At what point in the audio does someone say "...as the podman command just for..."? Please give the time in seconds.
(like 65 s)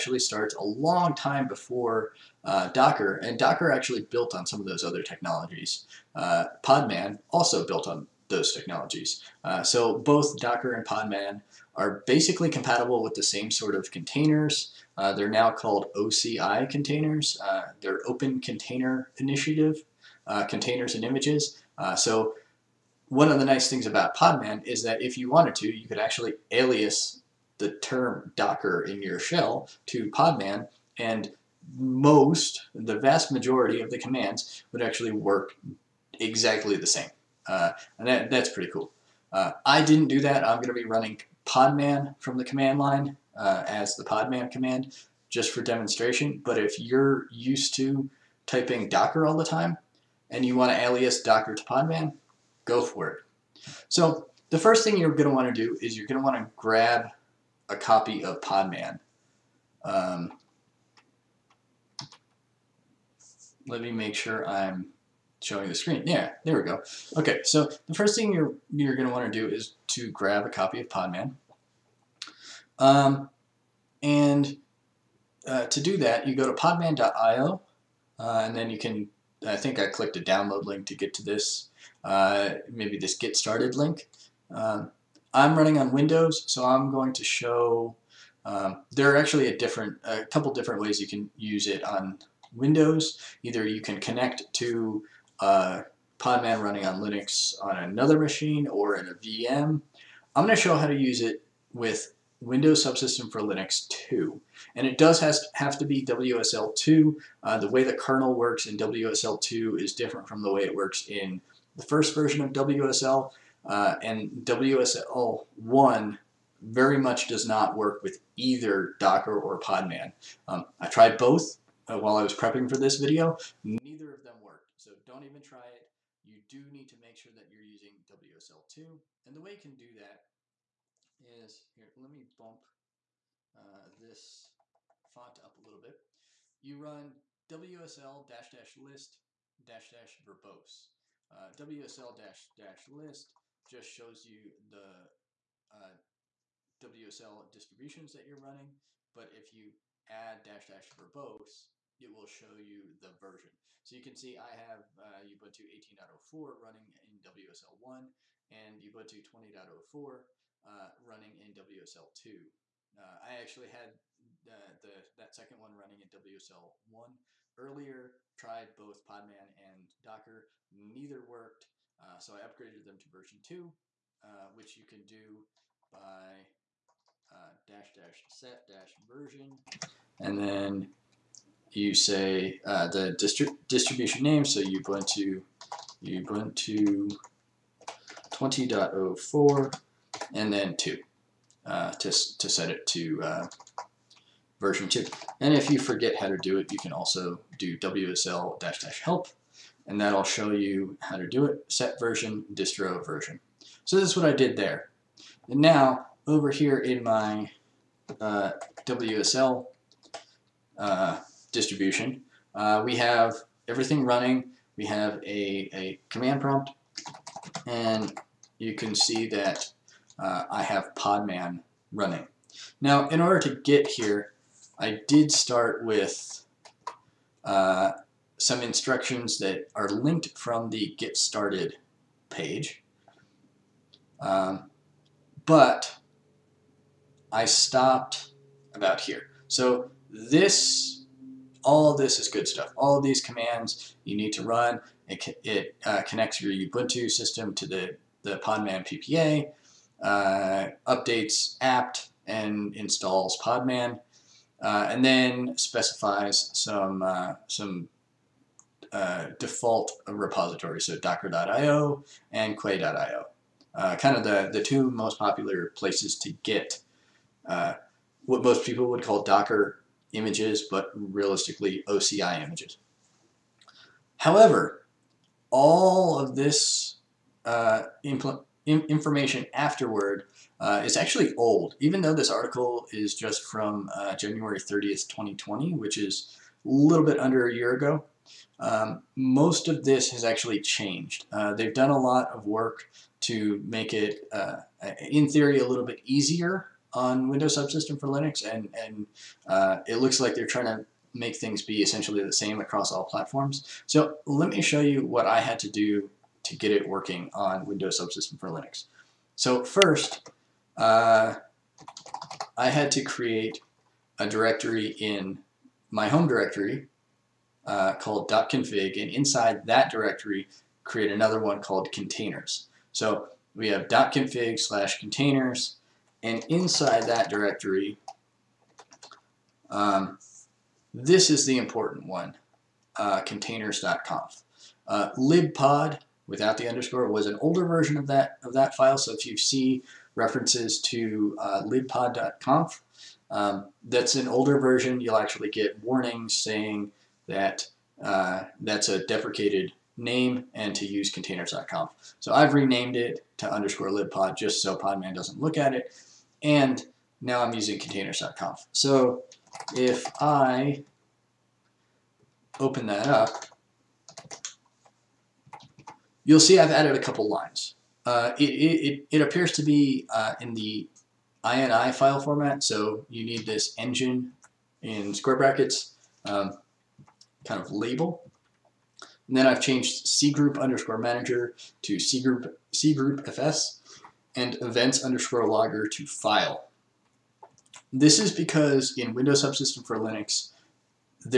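43 s.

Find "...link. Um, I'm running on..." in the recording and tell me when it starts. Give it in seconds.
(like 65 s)
83 s.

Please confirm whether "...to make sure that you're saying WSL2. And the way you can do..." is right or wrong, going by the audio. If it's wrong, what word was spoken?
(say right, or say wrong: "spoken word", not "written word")
wrong: "using", not "saying".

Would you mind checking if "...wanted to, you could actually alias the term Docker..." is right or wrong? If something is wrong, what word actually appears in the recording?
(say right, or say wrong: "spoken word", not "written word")
right.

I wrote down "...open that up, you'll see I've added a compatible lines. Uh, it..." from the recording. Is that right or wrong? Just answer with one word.
wrong.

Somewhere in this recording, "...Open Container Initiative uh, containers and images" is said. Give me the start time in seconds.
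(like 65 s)
18 s.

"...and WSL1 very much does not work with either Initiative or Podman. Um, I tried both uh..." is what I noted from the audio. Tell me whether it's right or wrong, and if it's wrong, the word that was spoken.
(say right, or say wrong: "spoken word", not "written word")
wrong: "Docker", not "Initiative".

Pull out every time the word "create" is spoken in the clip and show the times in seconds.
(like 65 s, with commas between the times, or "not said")
313 s, 320 s.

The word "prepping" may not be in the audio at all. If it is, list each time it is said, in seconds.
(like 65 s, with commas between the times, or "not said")
122 s.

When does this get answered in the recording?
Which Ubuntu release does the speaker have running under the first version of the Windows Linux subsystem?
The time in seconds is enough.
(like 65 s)
155 s.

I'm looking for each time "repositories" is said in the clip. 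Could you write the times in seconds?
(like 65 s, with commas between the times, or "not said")
260 s.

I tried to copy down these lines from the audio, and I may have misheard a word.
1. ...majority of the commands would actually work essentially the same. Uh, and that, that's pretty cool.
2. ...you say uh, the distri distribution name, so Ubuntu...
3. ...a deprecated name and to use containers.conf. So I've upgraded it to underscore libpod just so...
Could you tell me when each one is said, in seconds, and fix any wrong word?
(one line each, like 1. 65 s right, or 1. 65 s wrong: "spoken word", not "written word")
1. 33 s wrong: "exactly", not "essentially"
2. 181 s right
3. 348 s wrong: "renamed", not "upgraded".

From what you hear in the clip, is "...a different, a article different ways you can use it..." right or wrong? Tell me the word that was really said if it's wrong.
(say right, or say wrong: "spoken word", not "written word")
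wrong: "couple", not "article".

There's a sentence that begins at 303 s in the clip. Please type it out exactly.
So let me show you what I had to do to get it working on Windows Subsystem for Linux.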